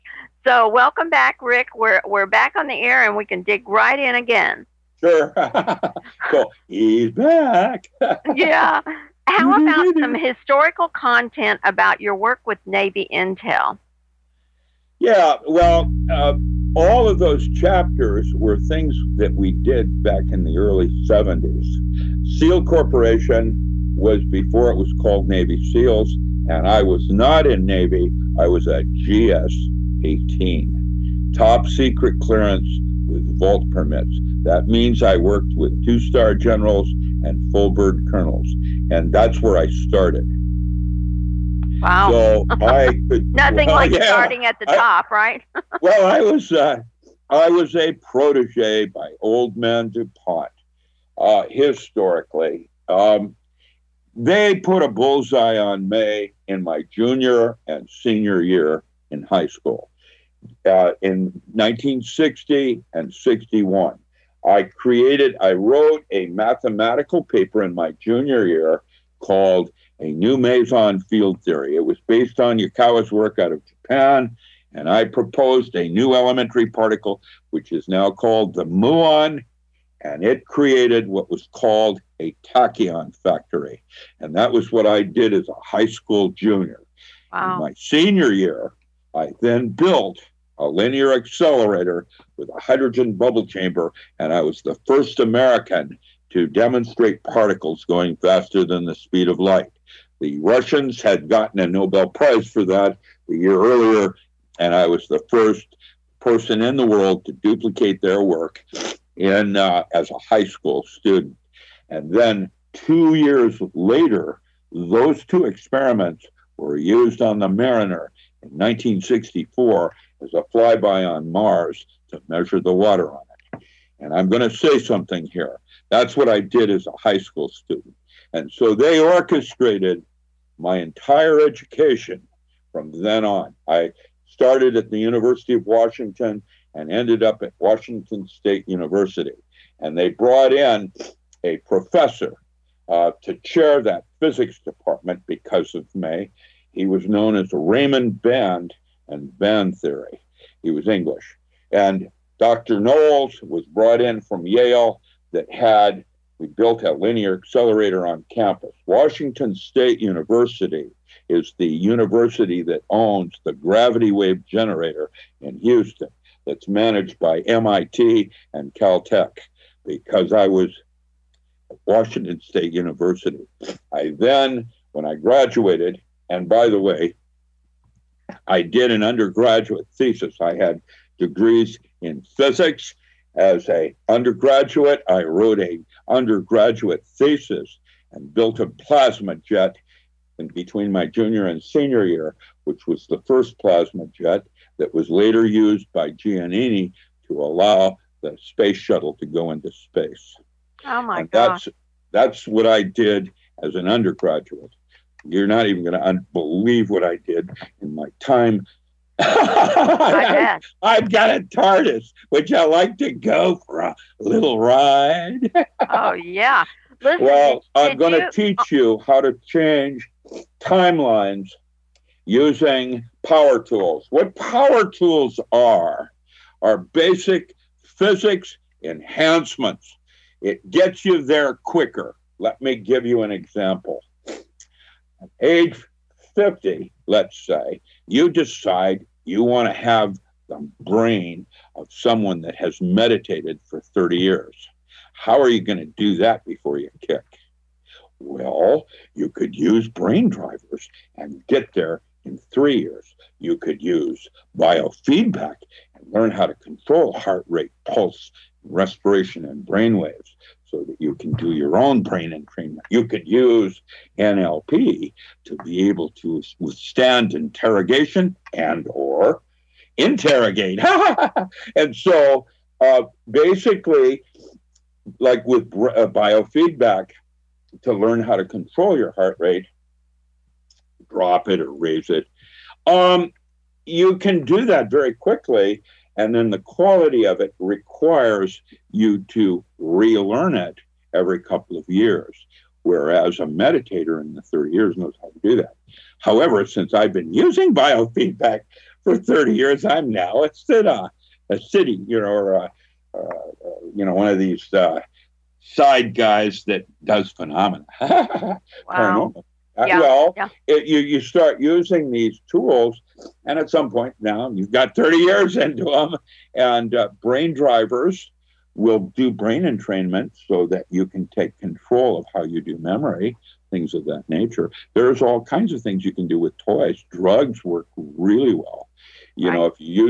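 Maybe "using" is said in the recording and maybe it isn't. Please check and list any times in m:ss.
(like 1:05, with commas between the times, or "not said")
3:42, 4:57, 5:11.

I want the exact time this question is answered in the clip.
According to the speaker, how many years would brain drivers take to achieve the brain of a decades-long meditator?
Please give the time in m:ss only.
4:12.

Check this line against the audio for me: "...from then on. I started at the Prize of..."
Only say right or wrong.
wrong.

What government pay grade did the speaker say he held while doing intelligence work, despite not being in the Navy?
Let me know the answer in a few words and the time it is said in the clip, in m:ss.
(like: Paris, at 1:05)
GS 18, at 0:28.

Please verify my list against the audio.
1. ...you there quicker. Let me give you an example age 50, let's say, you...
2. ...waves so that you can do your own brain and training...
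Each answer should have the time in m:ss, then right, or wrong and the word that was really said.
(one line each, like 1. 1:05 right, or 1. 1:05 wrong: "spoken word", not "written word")
1. 3:51 right
2. 4:19 right.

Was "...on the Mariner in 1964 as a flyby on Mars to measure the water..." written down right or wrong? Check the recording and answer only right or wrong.
right.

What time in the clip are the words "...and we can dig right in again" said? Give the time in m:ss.
0:03.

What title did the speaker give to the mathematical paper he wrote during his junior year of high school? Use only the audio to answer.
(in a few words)
A New Meson Field Theory.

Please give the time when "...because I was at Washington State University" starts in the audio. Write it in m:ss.
2:49.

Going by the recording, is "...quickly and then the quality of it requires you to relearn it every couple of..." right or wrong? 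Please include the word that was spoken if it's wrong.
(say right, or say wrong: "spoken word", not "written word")
right.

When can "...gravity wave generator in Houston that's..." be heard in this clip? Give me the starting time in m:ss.
2:43.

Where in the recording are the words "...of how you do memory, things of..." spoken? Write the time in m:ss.
5:22.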